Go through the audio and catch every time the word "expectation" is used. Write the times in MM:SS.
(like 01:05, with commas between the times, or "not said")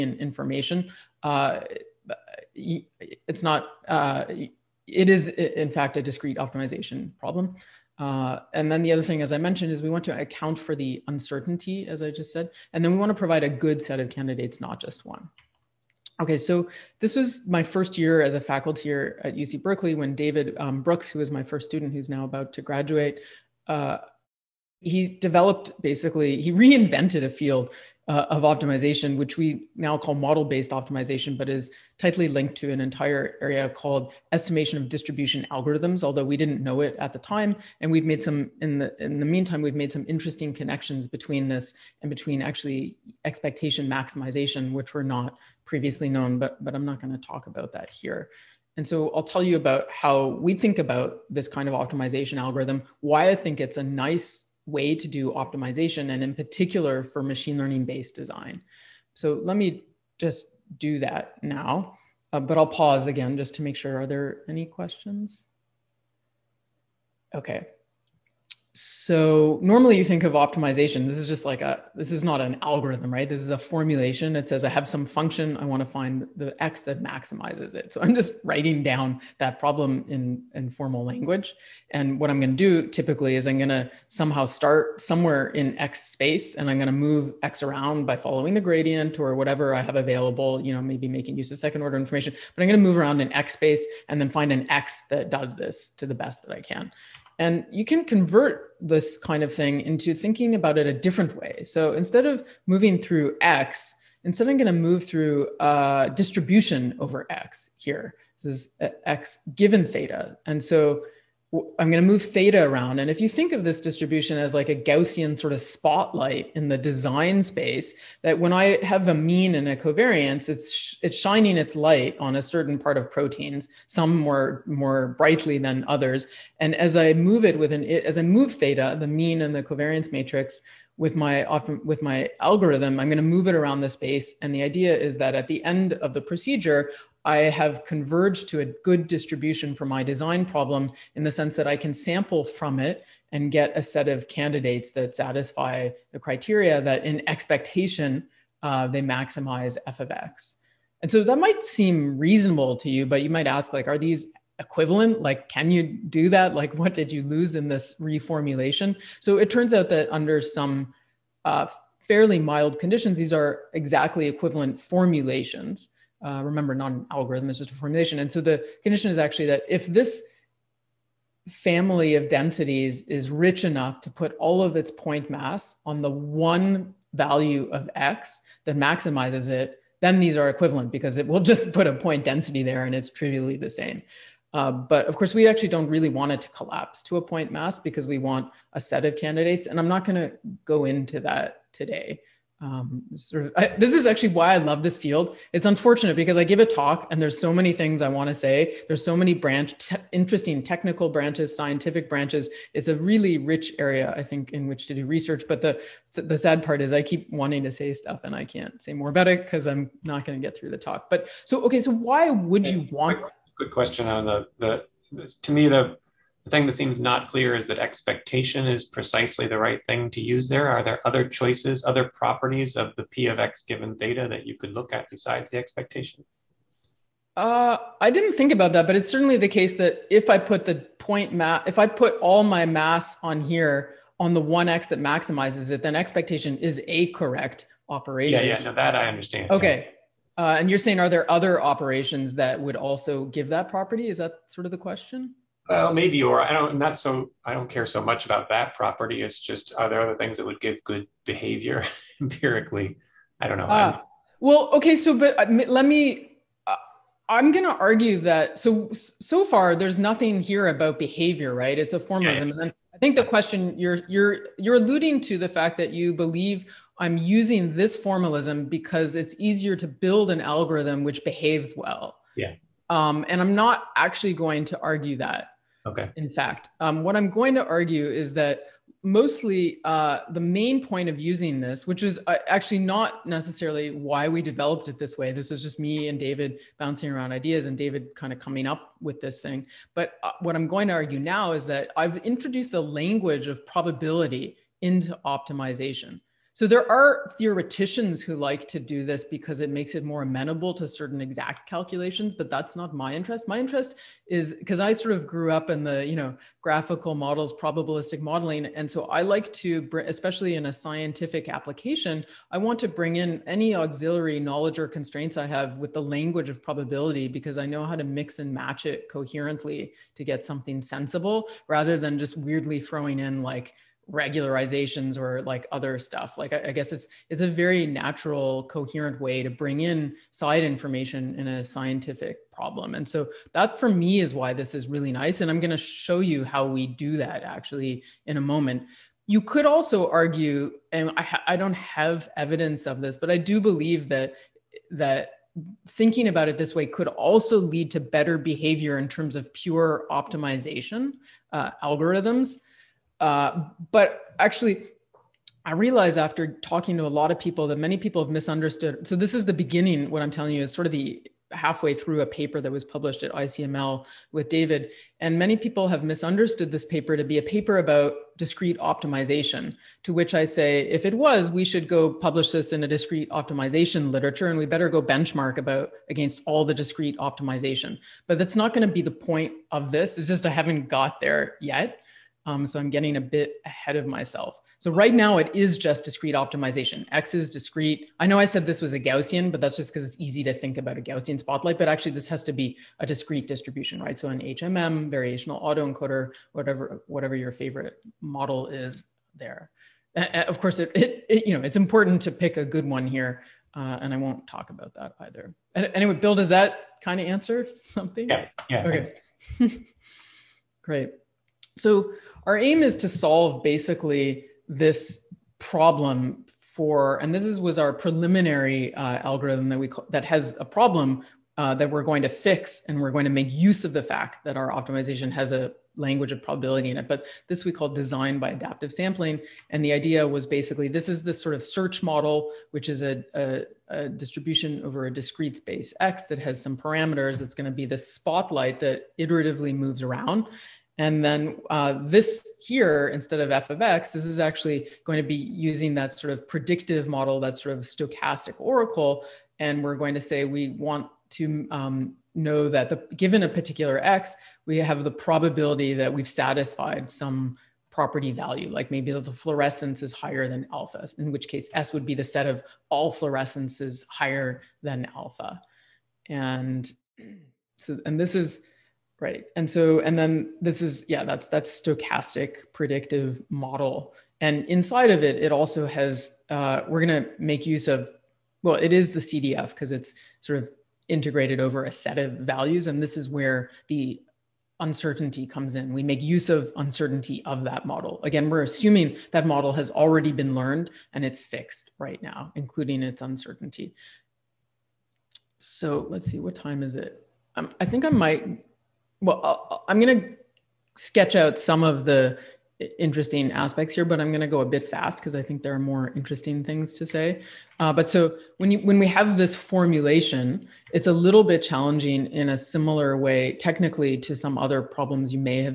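00:43, 02:27, 03:37, 03:45, 03:55.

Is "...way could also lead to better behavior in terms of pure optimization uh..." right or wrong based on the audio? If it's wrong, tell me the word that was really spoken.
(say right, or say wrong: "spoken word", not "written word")
right.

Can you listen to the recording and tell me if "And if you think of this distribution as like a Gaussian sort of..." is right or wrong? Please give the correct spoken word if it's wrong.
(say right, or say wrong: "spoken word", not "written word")
right.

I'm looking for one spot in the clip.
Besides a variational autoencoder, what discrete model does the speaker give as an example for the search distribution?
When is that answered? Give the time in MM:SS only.
06:34.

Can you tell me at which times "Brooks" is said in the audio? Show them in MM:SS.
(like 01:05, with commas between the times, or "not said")
00:20.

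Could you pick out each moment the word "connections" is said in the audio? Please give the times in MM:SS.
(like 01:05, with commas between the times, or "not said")
00:40.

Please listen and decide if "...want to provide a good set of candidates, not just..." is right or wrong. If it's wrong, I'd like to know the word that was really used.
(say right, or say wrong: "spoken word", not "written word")
right.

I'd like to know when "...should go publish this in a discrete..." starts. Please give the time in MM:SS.
06:11.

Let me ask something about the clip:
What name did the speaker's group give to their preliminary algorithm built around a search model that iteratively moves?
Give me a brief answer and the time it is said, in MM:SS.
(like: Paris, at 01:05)
design by adaptive sampling, at 07:07.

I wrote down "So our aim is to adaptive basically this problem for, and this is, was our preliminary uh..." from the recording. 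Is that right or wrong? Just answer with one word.
wrong.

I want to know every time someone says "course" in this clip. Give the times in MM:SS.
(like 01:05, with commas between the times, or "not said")
03:05, 06:40.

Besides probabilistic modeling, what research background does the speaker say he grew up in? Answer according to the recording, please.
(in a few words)
graphical models.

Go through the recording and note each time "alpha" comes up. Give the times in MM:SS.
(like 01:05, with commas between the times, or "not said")
07:40, 07:45.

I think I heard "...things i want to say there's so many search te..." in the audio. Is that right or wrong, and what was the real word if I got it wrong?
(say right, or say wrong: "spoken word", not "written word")
wrong: "branch", not "search".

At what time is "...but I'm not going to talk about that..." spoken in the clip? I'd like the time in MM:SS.
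00:46.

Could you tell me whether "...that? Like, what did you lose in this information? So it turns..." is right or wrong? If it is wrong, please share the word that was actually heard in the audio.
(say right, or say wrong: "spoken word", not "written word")
wrong: "reformulation", not "information".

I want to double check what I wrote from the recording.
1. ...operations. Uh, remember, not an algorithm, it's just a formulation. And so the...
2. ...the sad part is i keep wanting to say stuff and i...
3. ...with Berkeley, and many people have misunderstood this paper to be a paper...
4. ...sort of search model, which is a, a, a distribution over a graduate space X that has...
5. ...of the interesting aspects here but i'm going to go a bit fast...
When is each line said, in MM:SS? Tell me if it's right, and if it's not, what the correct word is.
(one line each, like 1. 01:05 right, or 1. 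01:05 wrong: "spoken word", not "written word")
1. 02:44 wrong: "formulations", not "operations"
2. 03:26 right
3. 06:04 wrong: "David", not "Berkeley"
4. 07:11 wrong: "discrete", not "graduate"
5. 08:21 right.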